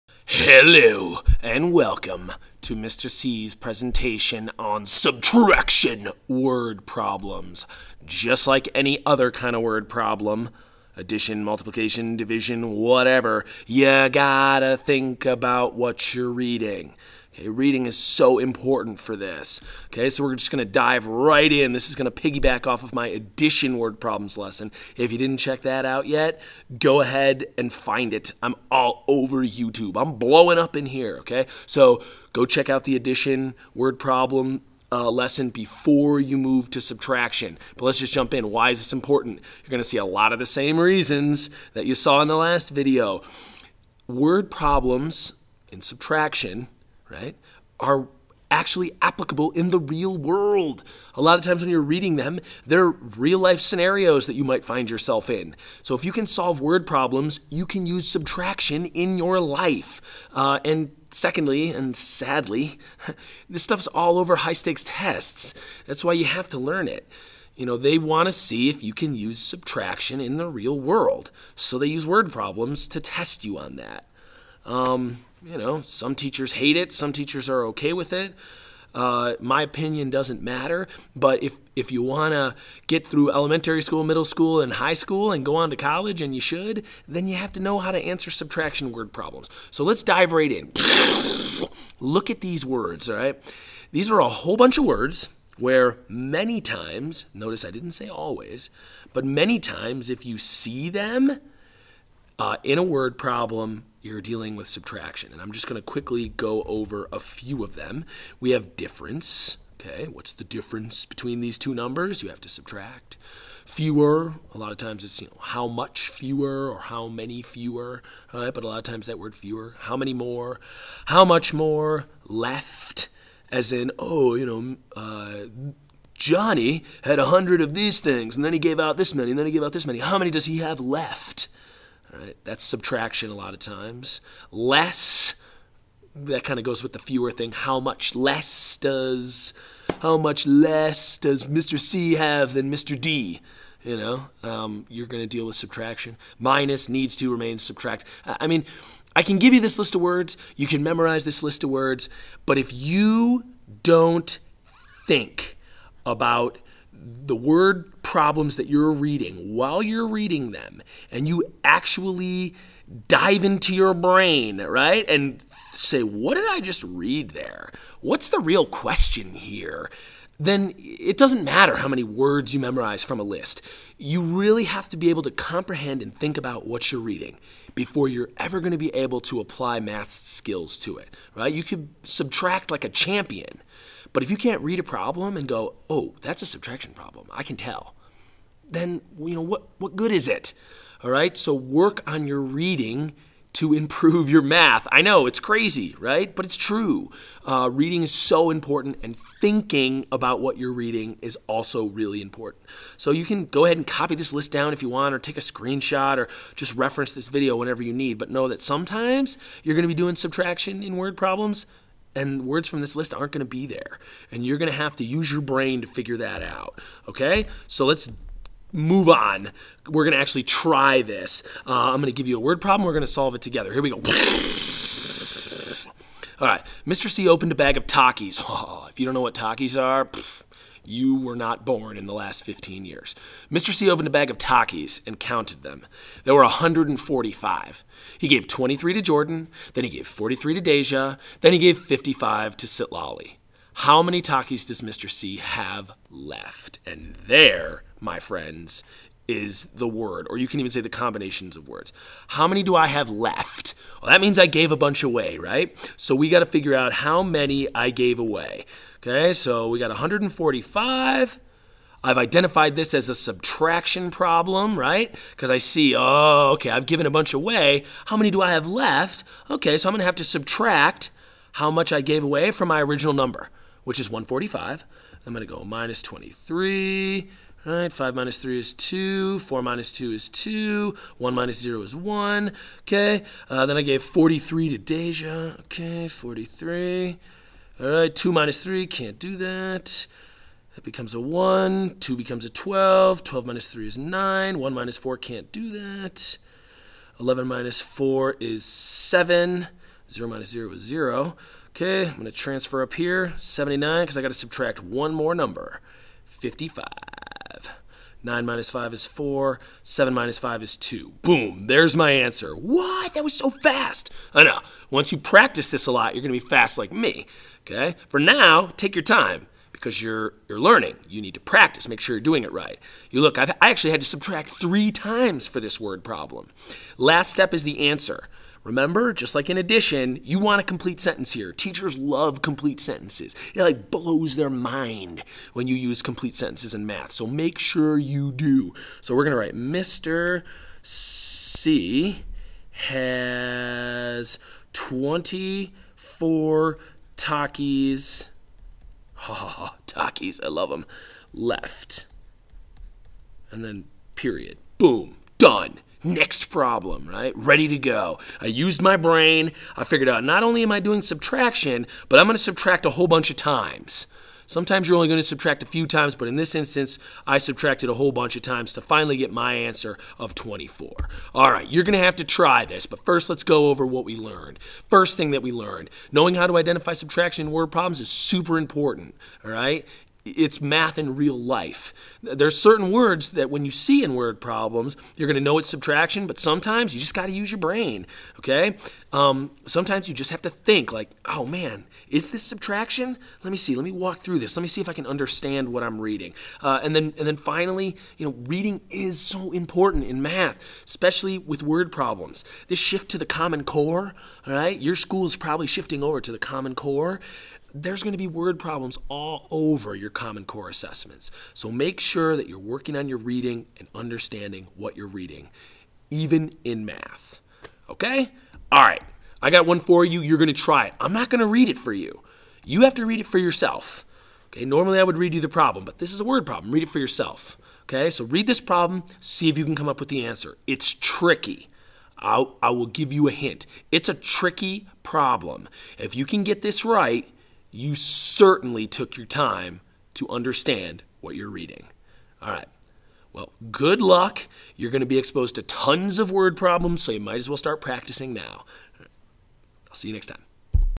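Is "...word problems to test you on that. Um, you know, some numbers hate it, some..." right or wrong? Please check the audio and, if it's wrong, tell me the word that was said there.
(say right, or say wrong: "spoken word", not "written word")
wrong: "teachers", not "numbers".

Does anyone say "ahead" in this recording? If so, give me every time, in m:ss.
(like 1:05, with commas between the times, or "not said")
0:26, 3:23.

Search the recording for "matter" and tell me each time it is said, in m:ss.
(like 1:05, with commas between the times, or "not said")
1:20, 2:51.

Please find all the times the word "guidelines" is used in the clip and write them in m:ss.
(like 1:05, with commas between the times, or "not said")
not said.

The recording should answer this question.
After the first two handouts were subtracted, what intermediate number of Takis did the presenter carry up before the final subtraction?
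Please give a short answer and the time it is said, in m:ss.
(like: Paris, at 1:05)
79, at 5:03.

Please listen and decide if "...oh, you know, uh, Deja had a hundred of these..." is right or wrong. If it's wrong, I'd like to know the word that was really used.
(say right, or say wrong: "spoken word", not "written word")
wrong: "Johnny", not "Deja".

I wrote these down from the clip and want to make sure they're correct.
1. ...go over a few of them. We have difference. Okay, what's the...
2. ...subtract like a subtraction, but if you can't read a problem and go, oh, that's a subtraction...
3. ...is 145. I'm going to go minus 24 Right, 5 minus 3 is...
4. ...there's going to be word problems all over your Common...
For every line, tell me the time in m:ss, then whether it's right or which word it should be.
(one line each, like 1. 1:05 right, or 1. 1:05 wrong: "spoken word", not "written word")
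1. 1:46 right
2. 3:02 wrong: "champion", not "subtraction"
3. 4:33 wrong: "23", not "24"
4. 6:47 right.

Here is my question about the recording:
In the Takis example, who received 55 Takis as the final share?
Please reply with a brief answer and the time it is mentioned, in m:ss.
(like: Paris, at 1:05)
Citlali, at 4:02.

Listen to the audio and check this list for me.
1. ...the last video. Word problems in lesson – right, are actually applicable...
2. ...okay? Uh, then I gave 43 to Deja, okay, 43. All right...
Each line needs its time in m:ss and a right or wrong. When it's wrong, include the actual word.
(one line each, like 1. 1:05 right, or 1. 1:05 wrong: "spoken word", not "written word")
1. 0:42 wrong: "subtraction", not "lesson"
2. 4:42 right.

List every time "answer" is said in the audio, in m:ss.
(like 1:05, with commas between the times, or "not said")
1:27, 5:12, 5:27, 6:09, 7:10.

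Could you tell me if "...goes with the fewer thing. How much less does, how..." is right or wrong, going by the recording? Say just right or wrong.
right.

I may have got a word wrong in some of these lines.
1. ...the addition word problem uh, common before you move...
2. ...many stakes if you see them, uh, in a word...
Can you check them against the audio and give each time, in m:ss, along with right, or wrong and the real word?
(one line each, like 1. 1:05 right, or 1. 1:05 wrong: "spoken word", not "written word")
1. 0:32 wrong: "lesson", not "common"
2. 1:39 wrong: "times", not "stakes".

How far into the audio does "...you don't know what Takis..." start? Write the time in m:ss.
3:48.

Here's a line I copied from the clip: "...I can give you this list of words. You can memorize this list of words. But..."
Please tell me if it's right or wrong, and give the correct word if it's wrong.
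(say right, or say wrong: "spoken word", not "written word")
right.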